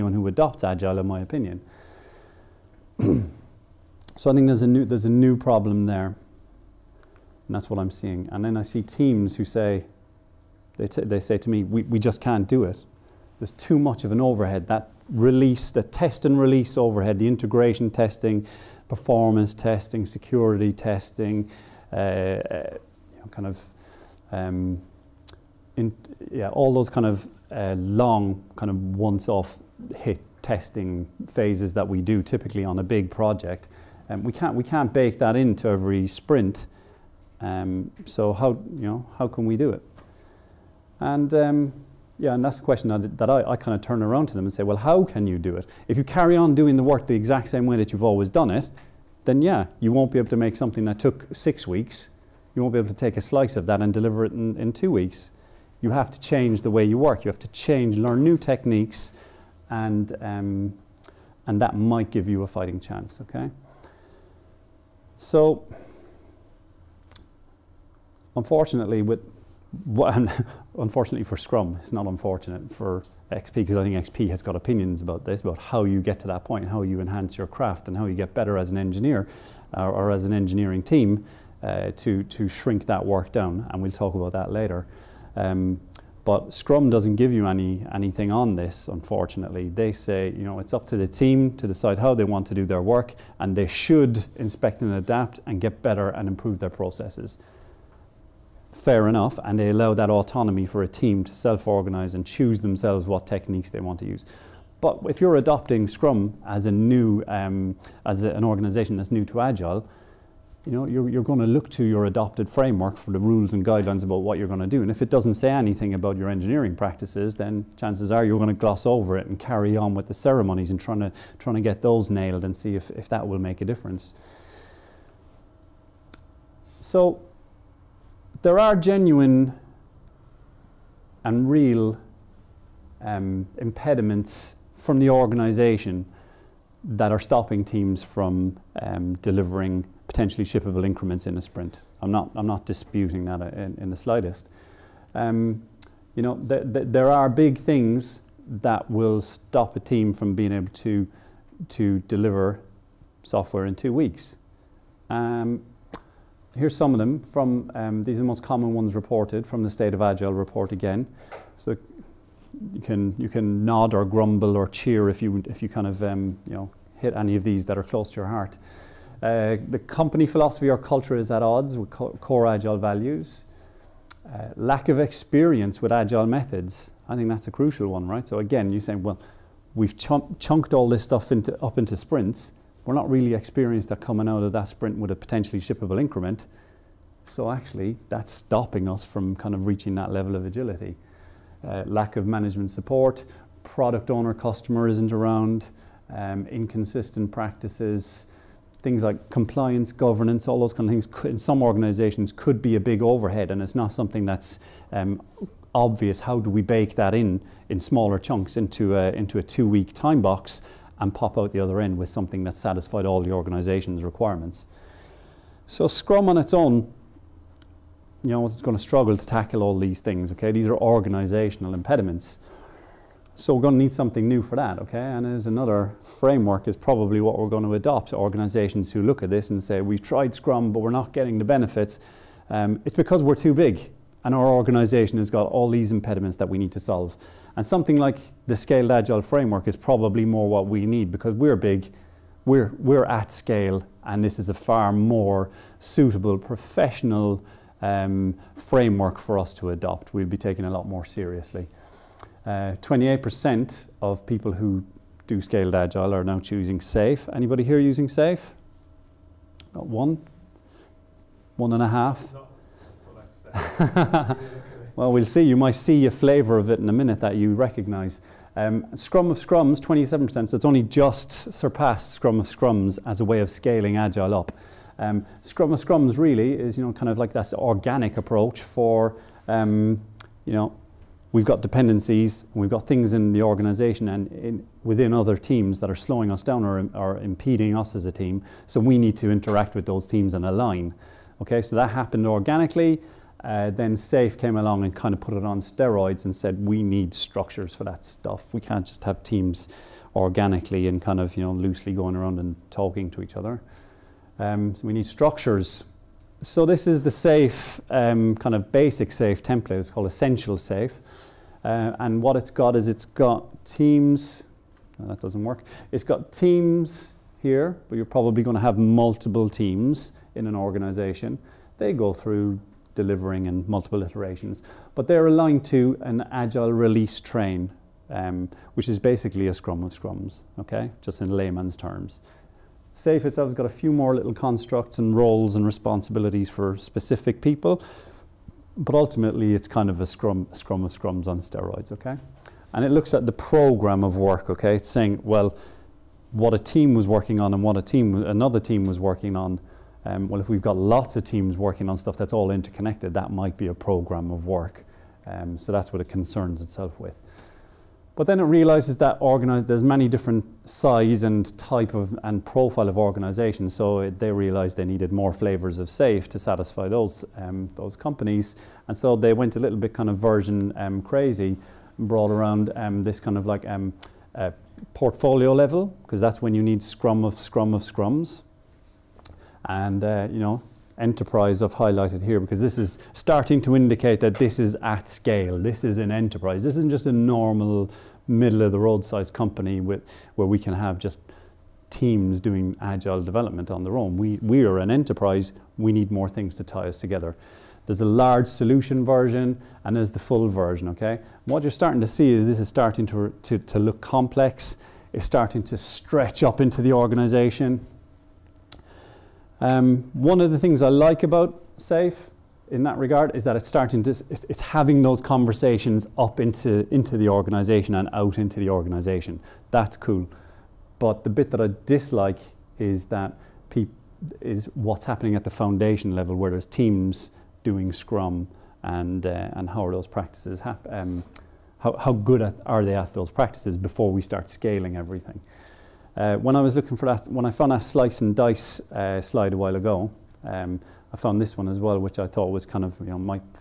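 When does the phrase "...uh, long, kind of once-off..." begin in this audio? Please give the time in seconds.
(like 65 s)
27 s.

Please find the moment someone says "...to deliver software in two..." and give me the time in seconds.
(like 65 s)
151 s.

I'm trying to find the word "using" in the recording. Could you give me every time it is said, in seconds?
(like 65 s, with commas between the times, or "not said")
257 s.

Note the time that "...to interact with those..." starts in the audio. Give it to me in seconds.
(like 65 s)
289 s.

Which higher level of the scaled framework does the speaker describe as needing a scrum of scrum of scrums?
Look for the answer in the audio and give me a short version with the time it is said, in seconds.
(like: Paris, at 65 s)
portfolio level, at 374 s.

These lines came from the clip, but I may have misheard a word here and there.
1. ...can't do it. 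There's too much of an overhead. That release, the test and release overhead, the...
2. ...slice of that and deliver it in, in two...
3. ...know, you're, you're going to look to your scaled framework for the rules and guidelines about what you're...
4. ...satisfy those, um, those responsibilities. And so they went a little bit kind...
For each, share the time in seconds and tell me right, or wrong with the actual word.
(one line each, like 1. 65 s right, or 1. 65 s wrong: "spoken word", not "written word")
1. 12 s right
2. 53 s right
3. 110 s wrong: "adopted", not "scaled"
4. 366 s wrong: "companies", not "responsibilities".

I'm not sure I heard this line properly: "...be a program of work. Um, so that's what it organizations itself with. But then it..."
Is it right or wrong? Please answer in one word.
wrong.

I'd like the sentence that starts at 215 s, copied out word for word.
So Scrum on its own, you know, it's going to struggle to tackle all these things, okay?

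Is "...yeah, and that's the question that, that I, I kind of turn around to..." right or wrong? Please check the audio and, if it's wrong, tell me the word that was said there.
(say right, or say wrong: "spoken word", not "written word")
right.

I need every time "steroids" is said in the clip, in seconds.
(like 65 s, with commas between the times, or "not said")
295 s, 341 s.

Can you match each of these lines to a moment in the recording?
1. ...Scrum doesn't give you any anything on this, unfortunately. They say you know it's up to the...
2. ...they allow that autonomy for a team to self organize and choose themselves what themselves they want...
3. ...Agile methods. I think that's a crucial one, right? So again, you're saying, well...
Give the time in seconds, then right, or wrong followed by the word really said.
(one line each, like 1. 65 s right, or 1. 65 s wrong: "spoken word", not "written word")
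1. 86 s right
2. 99 s wrong: "techniques", not "themselves"
3. 175 s right.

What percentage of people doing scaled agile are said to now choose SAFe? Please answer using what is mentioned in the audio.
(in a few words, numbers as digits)
28%.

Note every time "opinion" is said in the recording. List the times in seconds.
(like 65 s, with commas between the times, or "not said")
1 s, 74 s.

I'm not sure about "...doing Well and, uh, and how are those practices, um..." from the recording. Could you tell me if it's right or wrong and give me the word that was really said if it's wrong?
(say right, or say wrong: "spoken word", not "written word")
wrong: "Scrum", not "Well".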